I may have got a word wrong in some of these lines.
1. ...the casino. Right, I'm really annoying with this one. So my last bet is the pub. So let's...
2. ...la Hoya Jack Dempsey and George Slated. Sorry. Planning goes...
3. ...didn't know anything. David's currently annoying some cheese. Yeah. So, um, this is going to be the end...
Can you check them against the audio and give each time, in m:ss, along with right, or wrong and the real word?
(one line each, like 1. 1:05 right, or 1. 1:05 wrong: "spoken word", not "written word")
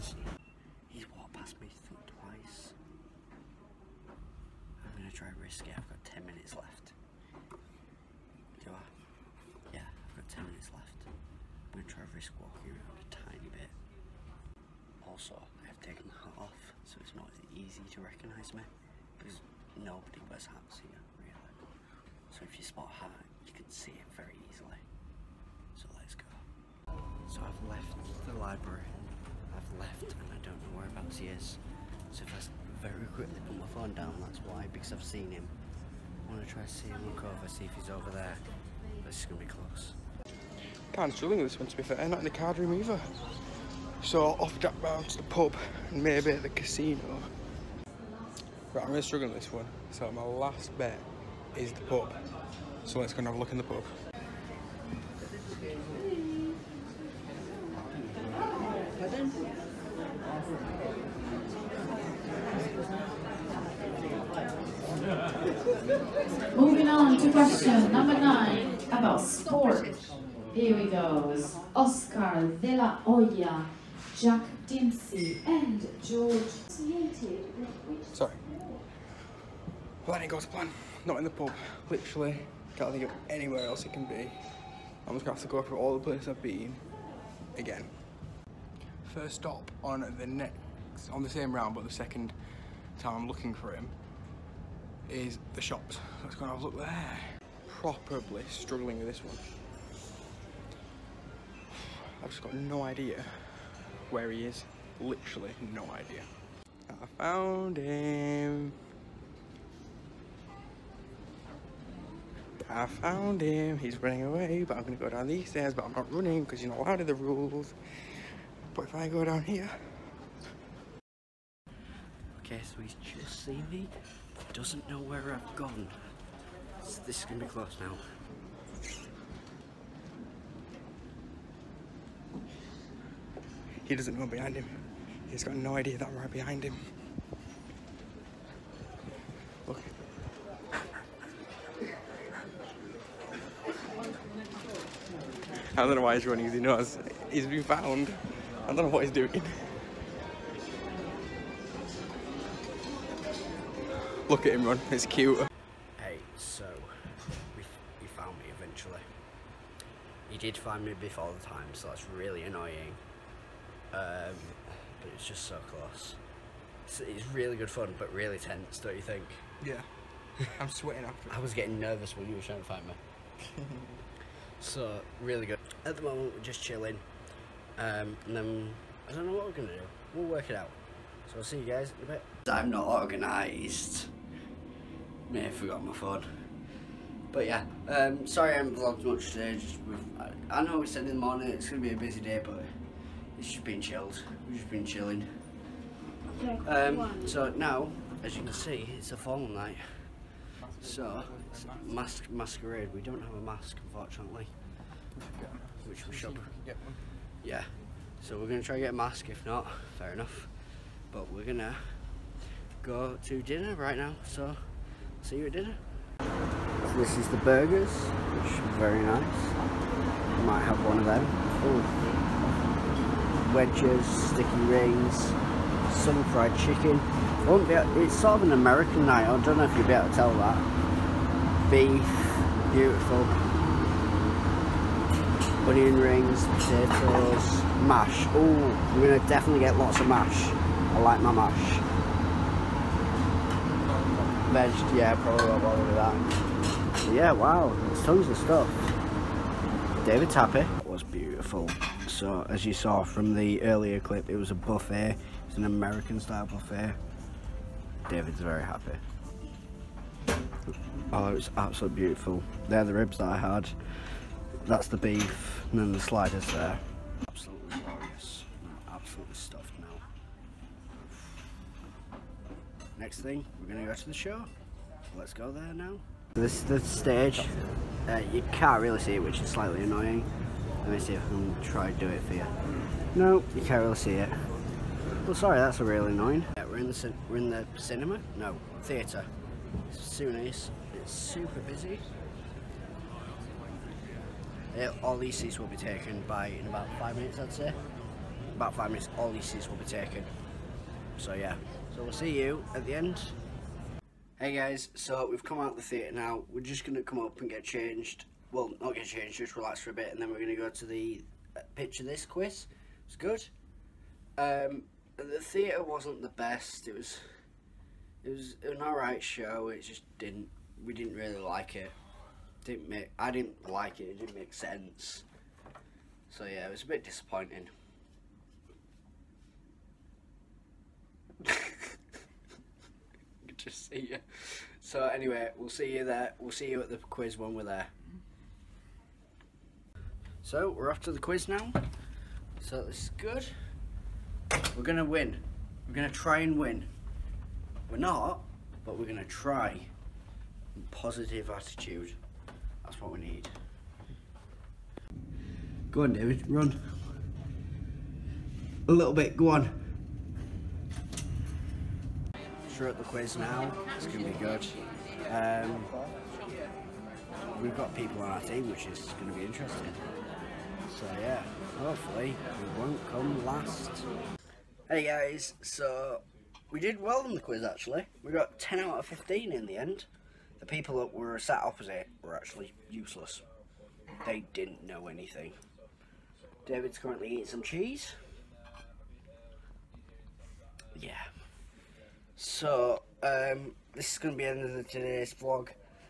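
1. 0:46 wrong: "struggling", not "annoying"
2. 1:12 right
3. 6:24 wrong: "eating", not "annoying".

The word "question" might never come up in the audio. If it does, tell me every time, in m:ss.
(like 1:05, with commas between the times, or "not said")
1:07.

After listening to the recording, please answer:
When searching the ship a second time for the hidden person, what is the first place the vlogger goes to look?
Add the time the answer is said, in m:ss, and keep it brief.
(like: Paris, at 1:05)
The shops, at 1:35.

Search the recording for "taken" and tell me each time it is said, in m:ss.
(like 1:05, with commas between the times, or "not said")
0:16, 4:55, 4:59.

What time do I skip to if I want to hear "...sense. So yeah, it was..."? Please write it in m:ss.
5:24.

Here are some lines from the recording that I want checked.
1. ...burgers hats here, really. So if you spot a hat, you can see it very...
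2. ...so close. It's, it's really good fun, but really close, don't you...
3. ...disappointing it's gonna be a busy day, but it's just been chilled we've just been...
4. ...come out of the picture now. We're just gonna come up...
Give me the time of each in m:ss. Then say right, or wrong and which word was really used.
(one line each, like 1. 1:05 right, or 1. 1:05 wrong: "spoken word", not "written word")
1. 0:20 wrong: "wears", not "burgers"
2. 2:45 wrong: "tense", not "close"
3. 3:11 wrong: "morning", not "disappointing"
4. 5:05 wrong: "theatre", not "picture".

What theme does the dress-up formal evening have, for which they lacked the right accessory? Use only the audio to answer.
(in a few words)
Masquerade.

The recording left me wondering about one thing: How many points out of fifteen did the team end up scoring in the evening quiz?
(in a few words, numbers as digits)
10.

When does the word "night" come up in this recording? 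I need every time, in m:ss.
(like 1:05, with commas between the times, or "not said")
3:19, 3:49.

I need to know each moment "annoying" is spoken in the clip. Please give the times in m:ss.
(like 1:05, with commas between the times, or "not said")
2:42, 4:39, 4:46.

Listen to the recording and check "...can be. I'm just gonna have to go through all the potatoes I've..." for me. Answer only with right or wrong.
wrong.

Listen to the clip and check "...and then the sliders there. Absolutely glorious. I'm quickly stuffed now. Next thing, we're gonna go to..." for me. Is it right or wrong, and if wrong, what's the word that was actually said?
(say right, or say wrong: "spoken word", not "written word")
wrong: "absolutely", not "quickly".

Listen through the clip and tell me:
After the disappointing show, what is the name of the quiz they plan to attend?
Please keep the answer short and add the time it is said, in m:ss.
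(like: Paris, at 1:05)
Picture This quiz, at 5:11.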